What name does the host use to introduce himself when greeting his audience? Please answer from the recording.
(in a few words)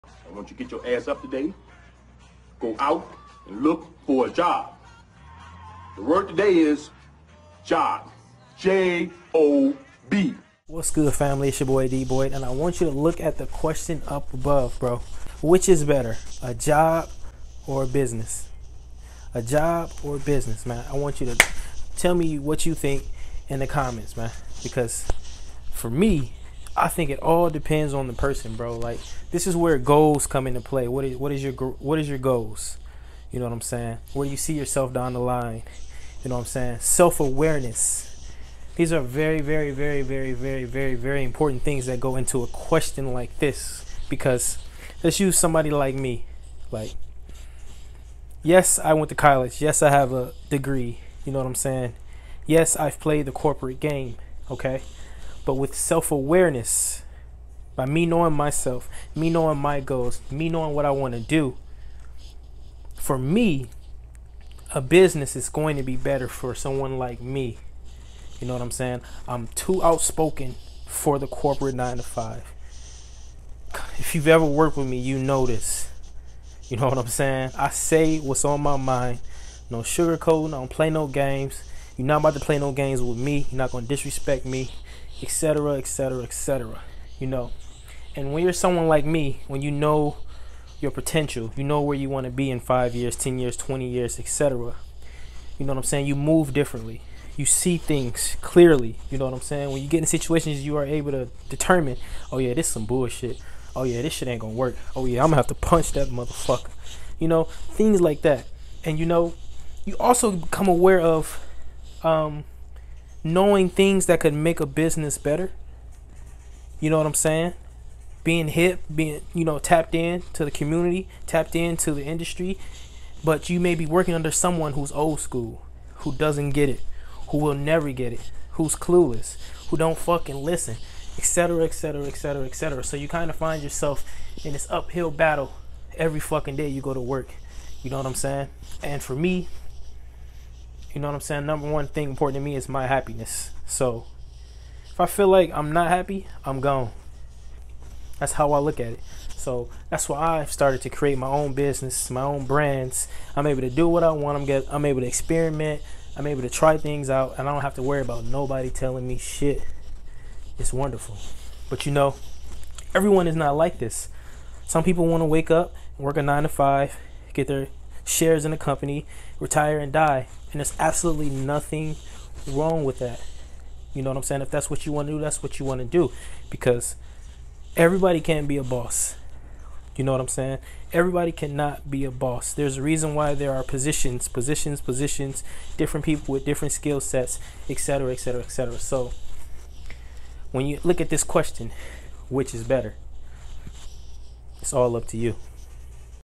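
D Boyd.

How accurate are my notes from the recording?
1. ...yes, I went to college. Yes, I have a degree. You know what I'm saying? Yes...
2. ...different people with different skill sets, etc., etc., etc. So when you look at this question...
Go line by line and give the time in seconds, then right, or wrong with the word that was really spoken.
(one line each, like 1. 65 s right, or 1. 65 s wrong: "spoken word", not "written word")
1. 48 s right
2. 185 s right.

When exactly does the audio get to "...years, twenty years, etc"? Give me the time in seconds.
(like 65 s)
93 s.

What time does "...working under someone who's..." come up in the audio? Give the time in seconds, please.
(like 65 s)
123 s.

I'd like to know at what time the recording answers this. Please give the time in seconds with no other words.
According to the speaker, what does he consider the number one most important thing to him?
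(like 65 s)
142 s.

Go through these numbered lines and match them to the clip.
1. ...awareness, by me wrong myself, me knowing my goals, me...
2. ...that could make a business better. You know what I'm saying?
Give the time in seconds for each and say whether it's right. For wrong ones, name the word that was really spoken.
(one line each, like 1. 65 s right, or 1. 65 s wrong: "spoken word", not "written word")
1. 56 s wrong: "knowing", not "wrong"
2. 114 s right.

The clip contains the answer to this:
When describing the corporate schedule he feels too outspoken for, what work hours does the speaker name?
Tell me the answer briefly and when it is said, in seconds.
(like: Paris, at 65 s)
nine to five, at 71 s.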